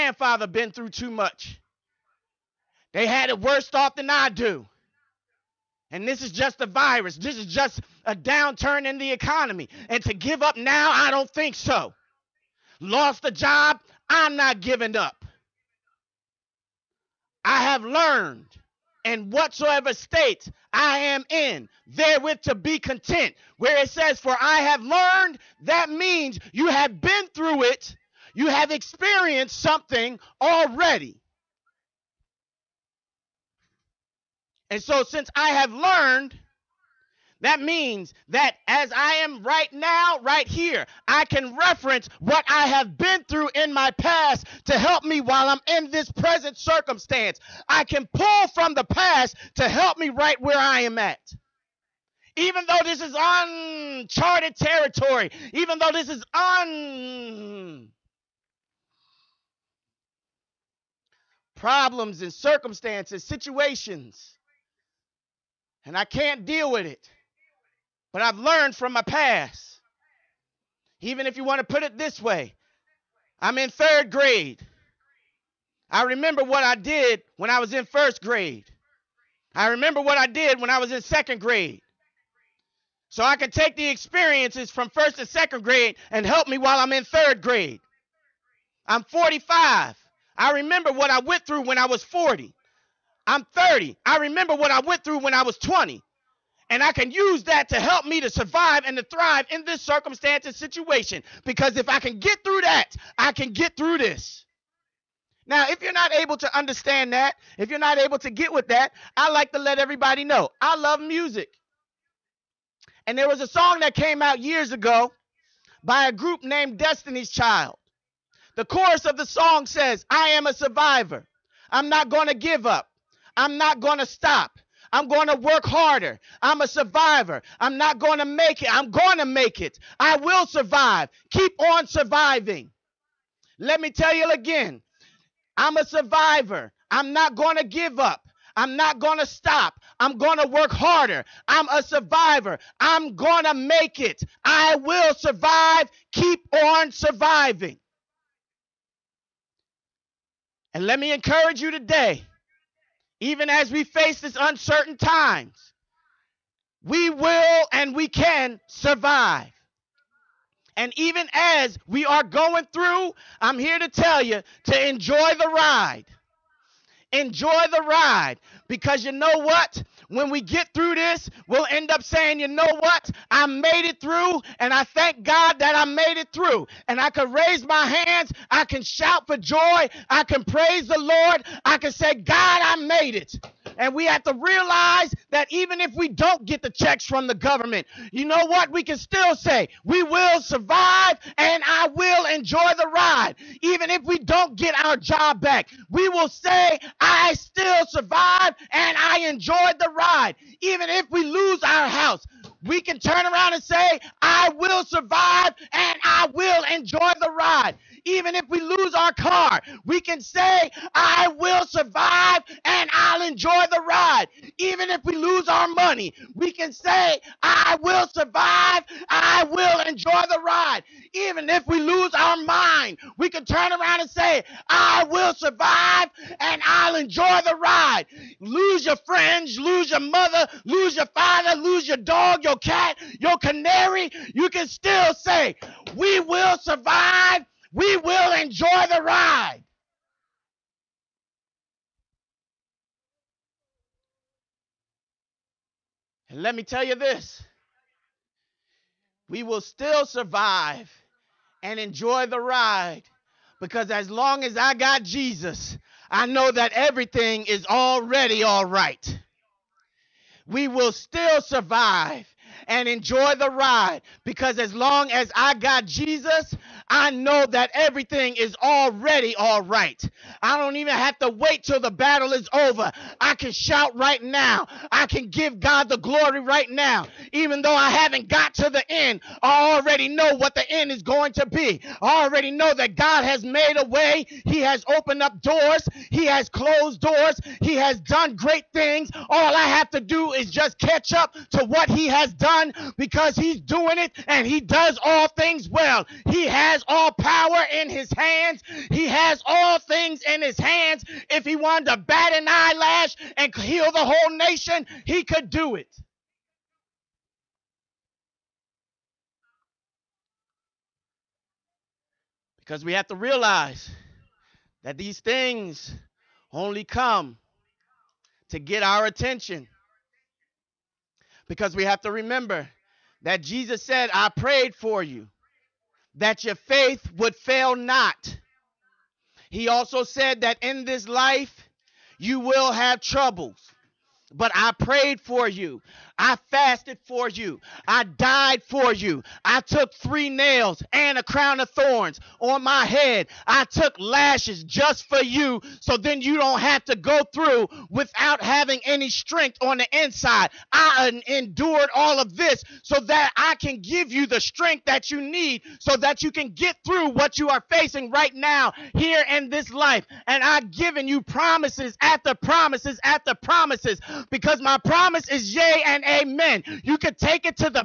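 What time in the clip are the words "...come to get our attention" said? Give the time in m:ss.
5:16.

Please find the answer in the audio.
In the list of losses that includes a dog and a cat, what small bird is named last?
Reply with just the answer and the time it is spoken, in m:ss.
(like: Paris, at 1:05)
canary, at 3:53.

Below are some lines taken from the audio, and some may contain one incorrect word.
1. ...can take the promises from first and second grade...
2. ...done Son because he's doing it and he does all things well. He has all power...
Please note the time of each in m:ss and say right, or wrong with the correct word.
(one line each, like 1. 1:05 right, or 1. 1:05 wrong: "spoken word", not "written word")
1. 1:23 wrong: "experiences", not "promises"
2. 4:52 right.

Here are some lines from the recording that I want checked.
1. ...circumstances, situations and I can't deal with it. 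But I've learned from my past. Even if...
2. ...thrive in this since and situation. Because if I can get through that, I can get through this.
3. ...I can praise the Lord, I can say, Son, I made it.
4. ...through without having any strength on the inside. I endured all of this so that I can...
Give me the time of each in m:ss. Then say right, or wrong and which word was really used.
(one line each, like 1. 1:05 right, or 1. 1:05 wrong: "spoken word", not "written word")
1. 1:02 right
2. 1:39 wrong: "circumstance", not "since"
3. 3:00 wrong: "God", not "Son"
4. 5:47 right.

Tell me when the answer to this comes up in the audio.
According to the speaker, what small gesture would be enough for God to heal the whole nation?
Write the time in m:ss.
5:01.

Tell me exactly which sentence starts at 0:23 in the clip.
Where it says, For I have learned, that means you have been through it, you have experienced something already.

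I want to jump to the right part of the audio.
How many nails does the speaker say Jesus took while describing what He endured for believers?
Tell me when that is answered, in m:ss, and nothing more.
5:39.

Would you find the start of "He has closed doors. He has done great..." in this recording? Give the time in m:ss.
4:46.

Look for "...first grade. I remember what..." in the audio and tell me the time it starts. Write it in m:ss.
1:17.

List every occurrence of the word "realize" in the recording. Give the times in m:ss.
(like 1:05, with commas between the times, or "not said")
3:04, 5:13.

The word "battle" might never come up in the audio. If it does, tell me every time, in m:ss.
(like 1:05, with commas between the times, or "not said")
4:31.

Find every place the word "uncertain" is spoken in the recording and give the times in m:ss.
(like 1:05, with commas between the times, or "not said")
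2:34.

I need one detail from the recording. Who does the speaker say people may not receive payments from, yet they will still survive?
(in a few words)
the government.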